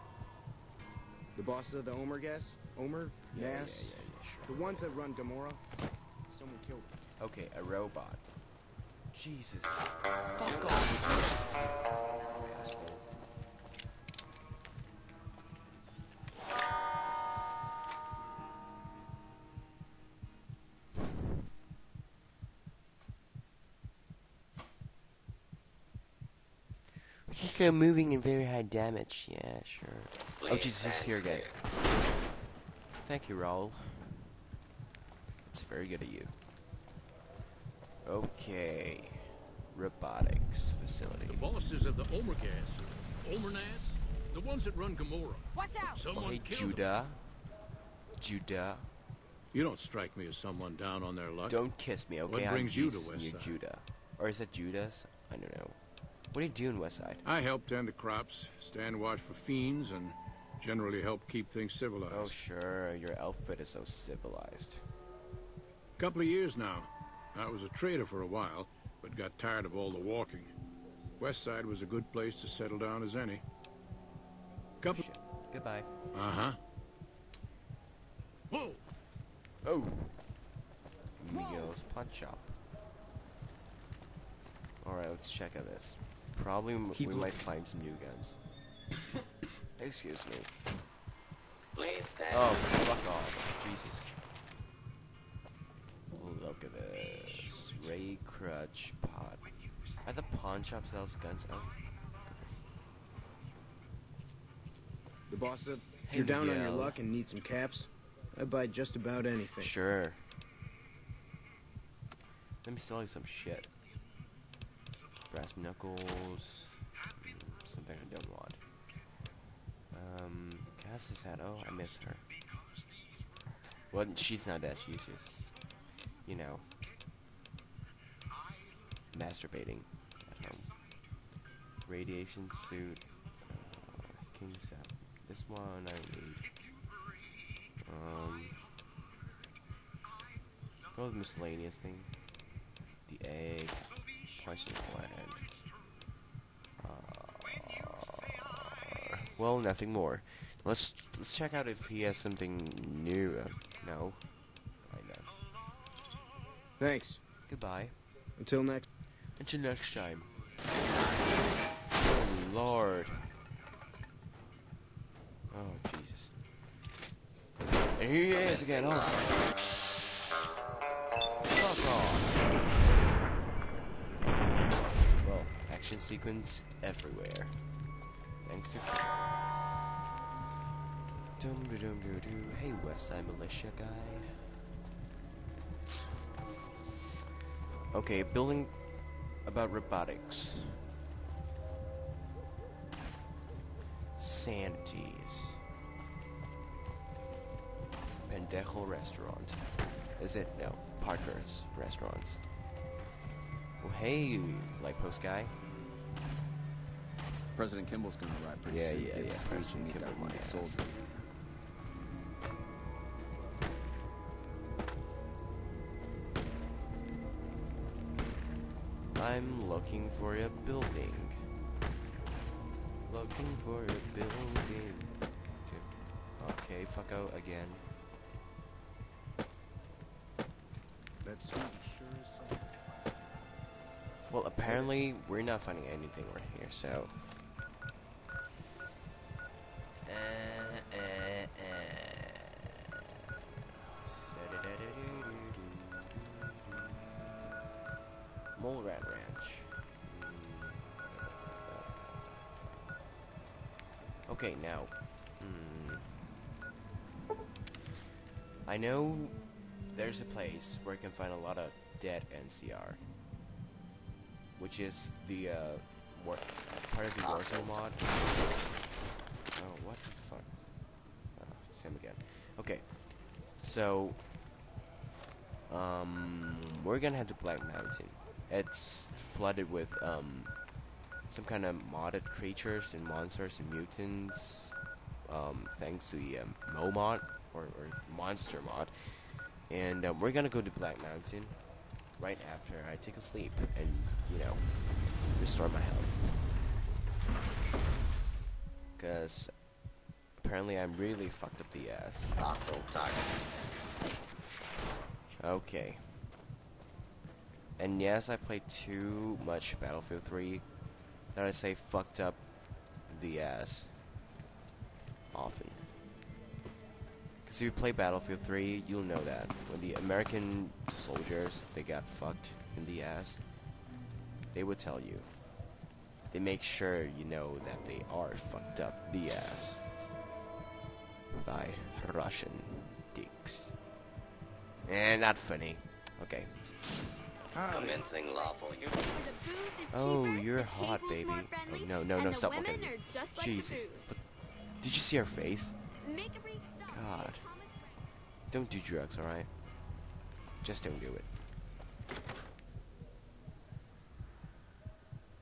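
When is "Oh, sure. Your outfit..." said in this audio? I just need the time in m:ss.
1:02.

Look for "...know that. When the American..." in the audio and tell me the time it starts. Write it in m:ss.
5:19.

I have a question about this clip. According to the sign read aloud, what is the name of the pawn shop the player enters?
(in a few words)
Miguel's Pawn Shop.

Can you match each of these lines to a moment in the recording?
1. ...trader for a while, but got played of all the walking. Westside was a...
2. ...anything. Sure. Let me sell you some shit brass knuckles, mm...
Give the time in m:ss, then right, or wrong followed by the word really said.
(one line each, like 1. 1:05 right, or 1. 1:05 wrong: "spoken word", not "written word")
1. 1:07 wrong: "tired", not "played"
2. 1:49 right.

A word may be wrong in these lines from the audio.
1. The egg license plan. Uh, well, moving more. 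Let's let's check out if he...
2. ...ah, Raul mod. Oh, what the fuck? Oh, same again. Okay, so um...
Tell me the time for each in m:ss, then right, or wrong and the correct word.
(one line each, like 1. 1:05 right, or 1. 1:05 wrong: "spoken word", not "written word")
1. 2:23 wrong: "nothing", not "moving"
2. 4:27 wrong: "Warzone", not "Raul".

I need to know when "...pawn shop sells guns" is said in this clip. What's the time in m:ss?
1:40.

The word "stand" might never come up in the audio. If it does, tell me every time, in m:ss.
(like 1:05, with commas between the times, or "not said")
0:58, 1:32.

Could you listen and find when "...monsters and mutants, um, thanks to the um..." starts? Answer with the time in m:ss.
4:43.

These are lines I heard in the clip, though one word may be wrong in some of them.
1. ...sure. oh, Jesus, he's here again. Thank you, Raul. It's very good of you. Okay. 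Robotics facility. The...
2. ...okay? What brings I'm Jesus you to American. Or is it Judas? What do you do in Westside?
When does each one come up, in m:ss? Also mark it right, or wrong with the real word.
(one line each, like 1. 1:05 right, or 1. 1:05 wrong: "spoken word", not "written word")
1. 0:29 right
2. 0:52 wrong: "Judah", not "American".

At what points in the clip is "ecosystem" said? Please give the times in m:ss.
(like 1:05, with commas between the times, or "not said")
not said.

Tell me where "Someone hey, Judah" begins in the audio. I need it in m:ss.
0:45.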